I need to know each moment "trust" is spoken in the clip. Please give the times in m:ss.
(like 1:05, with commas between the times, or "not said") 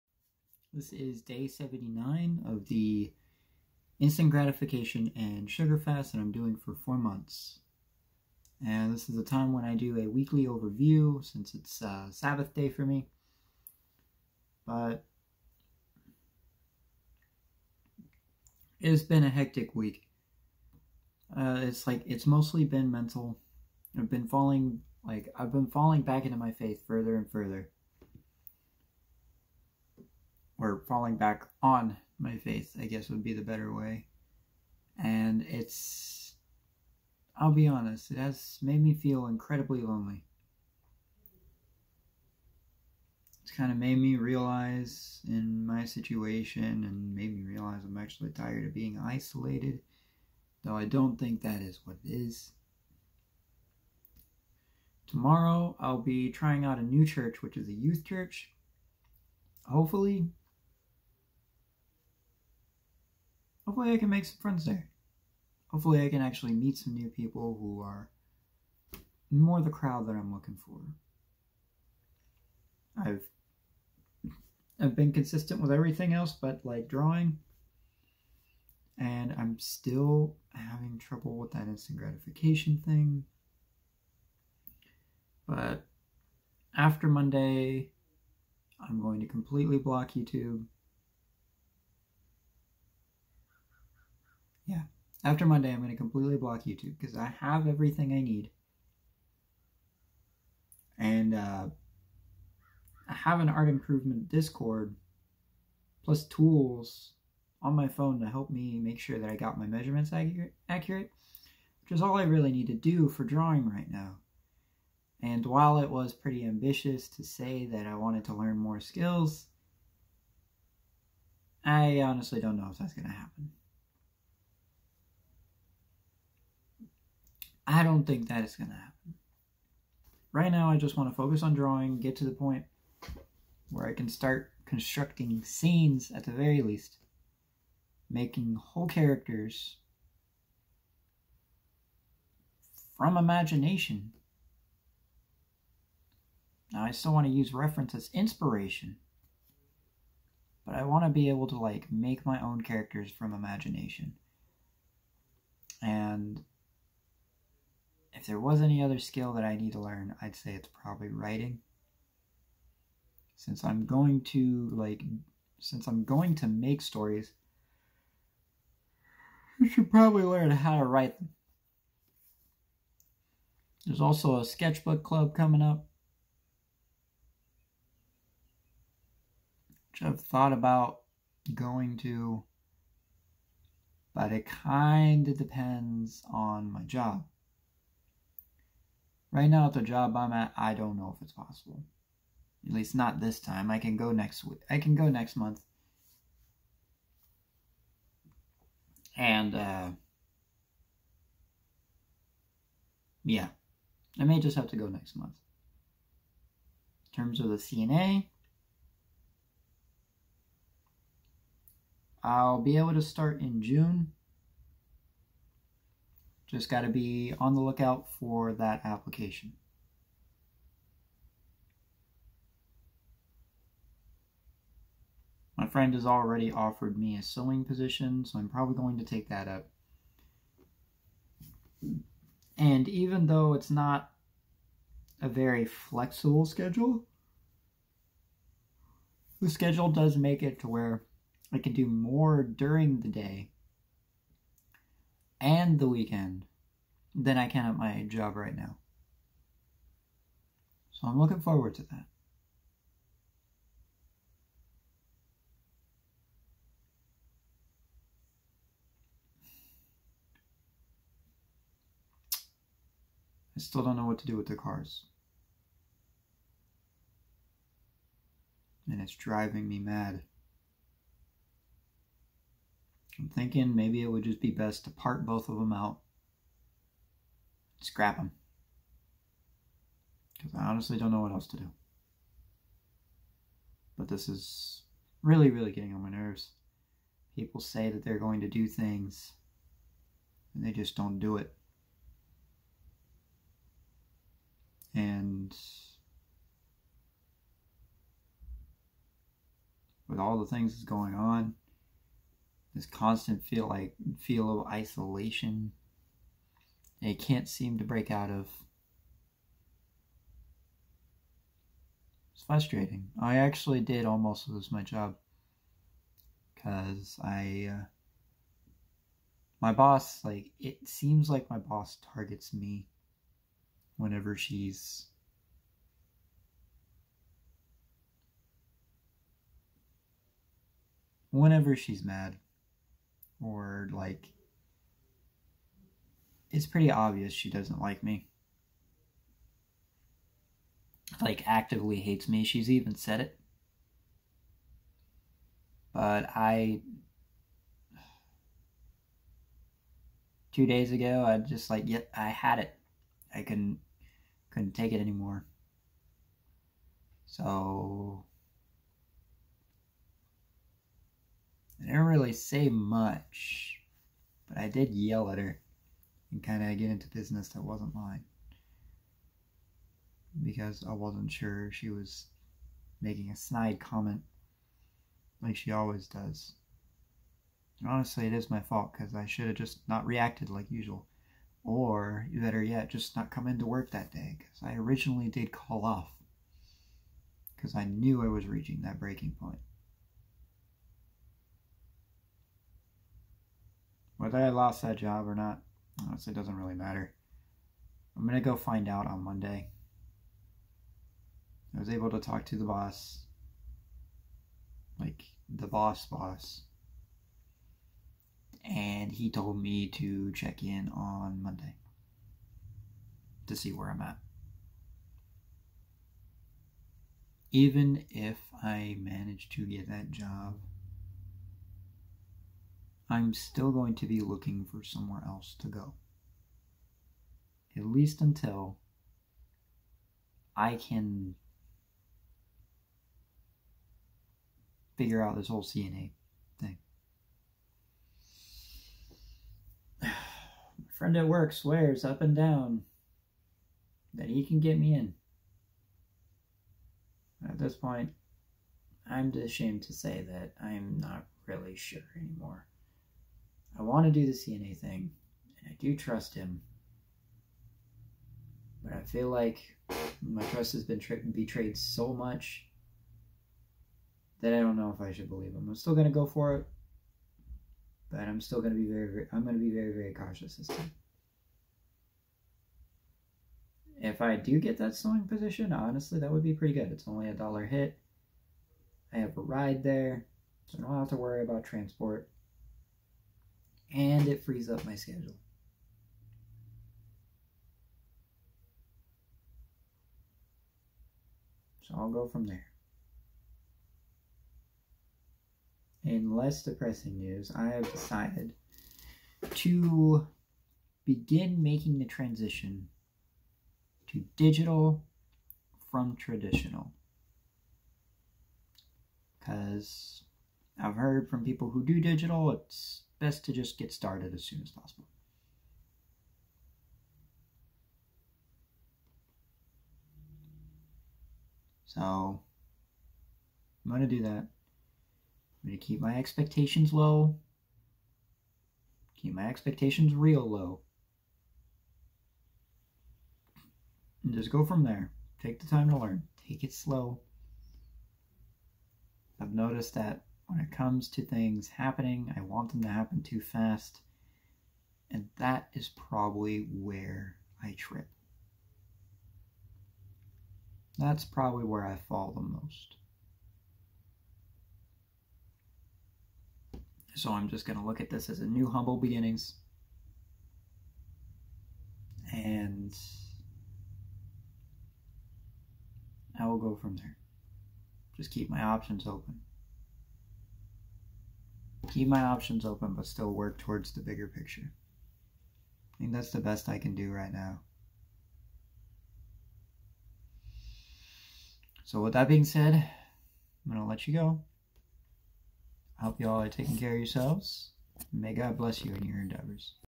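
7:35, 7:40.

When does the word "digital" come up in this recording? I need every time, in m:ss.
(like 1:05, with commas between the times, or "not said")
8:24, 8:31.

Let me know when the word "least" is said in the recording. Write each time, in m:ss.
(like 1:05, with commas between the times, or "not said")
2:16, 3:12, 7:07.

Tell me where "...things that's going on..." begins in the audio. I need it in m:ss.
5:00.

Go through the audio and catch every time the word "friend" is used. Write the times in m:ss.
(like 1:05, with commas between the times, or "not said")
1:04, 3:45, 7:20.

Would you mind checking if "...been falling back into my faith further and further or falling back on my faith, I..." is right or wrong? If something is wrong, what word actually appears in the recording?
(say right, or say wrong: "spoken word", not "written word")
right.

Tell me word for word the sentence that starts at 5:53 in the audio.
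I couldn't, couldn't take it anymore.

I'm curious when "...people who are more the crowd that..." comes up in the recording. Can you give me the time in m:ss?
1:07.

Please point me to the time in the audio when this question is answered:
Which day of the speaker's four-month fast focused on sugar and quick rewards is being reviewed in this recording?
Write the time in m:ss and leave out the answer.
0:01.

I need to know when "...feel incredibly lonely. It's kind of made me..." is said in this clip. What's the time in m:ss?
0:38.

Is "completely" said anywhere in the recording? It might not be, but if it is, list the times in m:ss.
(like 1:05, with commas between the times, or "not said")
1:29, 1:35.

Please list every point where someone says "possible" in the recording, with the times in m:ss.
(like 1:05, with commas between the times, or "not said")
3:11, 8:34.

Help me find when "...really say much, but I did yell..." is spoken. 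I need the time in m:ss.
6:02.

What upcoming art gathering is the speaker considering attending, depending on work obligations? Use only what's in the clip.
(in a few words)
Sketchbook club.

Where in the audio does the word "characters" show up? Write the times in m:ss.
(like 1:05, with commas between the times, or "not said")
2:18, 2:32.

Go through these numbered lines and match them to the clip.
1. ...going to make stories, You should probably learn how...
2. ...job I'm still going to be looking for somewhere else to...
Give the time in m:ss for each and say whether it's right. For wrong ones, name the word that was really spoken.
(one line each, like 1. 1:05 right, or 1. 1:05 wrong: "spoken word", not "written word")
1. 2:46 right
2. 7:00 right.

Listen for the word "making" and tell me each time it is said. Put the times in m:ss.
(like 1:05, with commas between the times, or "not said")
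2:18, 6:13, 8:21.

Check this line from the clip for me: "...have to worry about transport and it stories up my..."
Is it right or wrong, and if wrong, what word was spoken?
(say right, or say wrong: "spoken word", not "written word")
wrong: "frees", not "stories".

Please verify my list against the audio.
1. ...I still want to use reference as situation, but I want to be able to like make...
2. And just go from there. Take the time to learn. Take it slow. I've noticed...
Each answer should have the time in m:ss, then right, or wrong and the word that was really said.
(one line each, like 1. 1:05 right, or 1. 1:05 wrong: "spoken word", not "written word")
1. 2:26 wrong: "inspiration", not "situation"
2. 8:54 right.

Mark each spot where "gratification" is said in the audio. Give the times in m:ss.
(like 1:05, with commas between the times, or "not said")
0:04, 1:21.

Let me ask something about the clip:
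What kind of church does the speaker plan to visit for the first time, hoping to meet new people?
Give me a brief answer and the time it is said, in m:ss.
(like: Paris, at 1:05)
Youth church, at 0:57.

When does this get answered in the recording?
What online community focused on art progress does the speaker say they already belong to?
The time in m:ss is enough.
1:43.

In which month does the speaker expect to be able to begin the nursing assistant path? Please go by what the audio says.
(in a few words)
June.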